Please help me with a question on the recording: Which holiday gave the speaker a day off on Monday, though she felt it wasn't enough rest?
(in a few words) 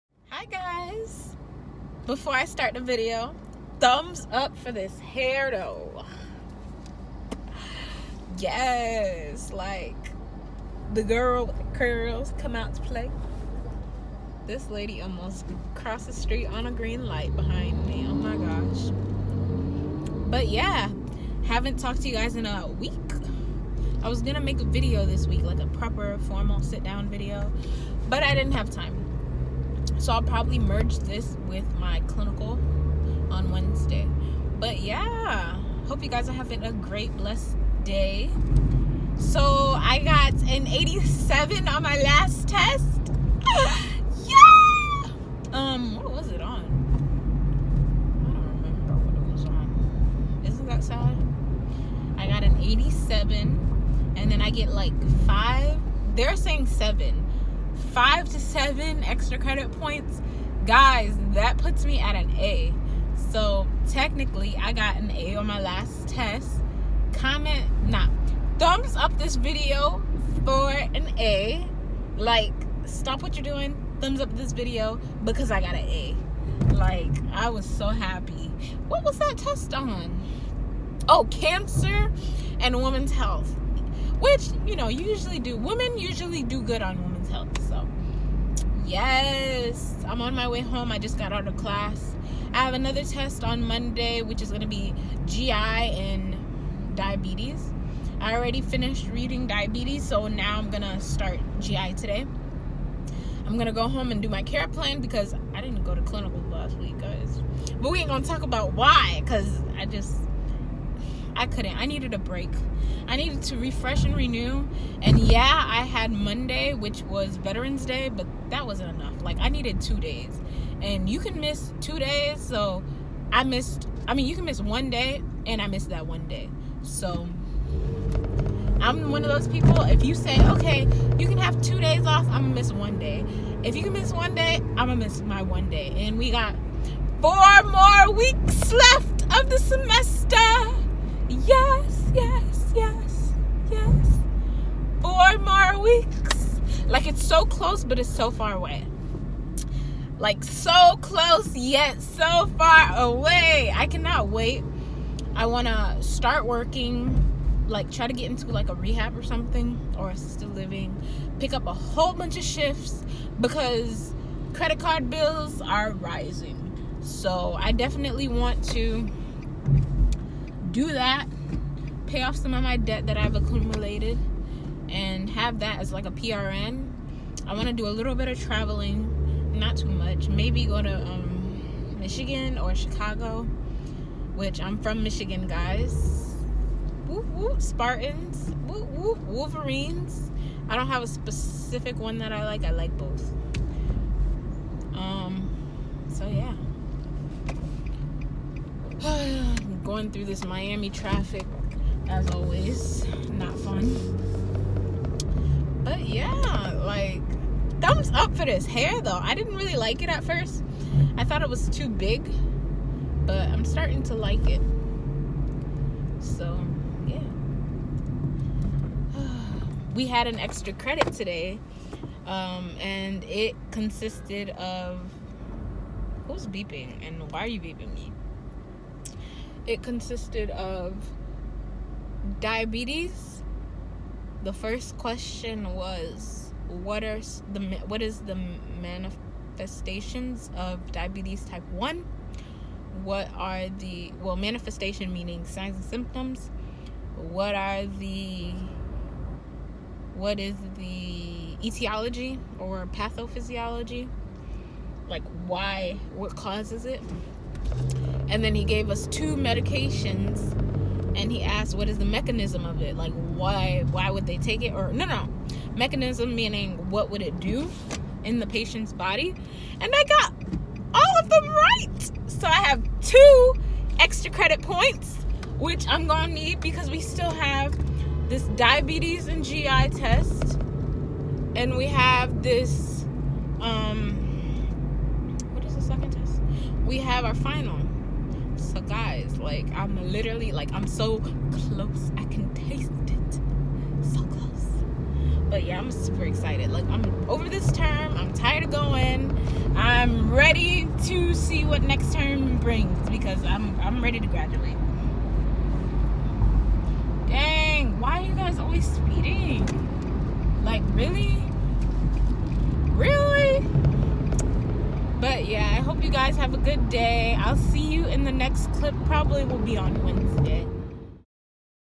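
Veterans Day.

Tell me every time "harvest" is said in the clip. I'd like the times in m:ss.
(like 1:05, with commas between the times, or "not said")
not said.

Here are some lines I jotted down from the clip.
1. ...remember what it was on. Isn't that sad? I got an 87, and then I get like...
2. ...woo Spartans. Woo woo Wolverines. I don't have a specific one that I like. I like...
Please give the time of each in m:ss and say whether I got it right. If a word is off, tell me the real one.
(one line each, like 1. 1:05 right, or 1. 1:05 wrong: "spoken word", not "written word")
1. 0:48 right
2. 3:07 right.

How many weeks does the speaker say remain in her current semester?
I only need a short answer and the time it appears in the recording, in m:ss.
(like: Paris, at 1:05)
4, at 2:17.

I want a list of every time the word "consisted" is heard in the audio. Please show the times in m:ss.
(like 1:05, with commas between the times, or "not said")
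3:43, 3:49.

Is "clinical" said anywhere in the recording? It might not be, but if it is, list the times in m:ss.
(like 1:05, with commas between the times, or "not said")
0:32, 1:46.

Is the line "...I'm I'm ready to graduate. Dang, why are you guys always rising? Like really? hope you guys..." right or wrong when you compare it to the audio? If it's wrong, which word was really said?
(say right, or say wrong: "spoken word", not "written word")
wrong: "speeding", not "rising".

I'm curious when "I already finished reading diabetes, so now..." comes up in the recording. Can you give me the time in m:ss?
1:38.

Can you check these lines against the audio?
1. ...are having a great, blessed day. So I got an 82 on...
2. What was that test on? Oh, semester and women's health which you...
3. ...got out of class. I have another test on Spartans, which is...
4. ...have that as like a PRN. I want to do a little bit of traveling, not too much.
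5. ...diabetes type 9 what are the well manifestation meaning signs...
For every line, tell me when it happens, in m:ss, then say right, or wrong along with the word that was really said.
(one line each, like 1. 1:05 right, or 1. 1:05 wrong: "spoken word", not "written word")
1. 0:36 wrong: "87", not "82"
2. 1:18 wrong: "cancer", not "semester"
3. 1:31 wrong: "Monday", not "Spartans"
4. 2:55 right
5. 4:00 wrong: "1", not "9".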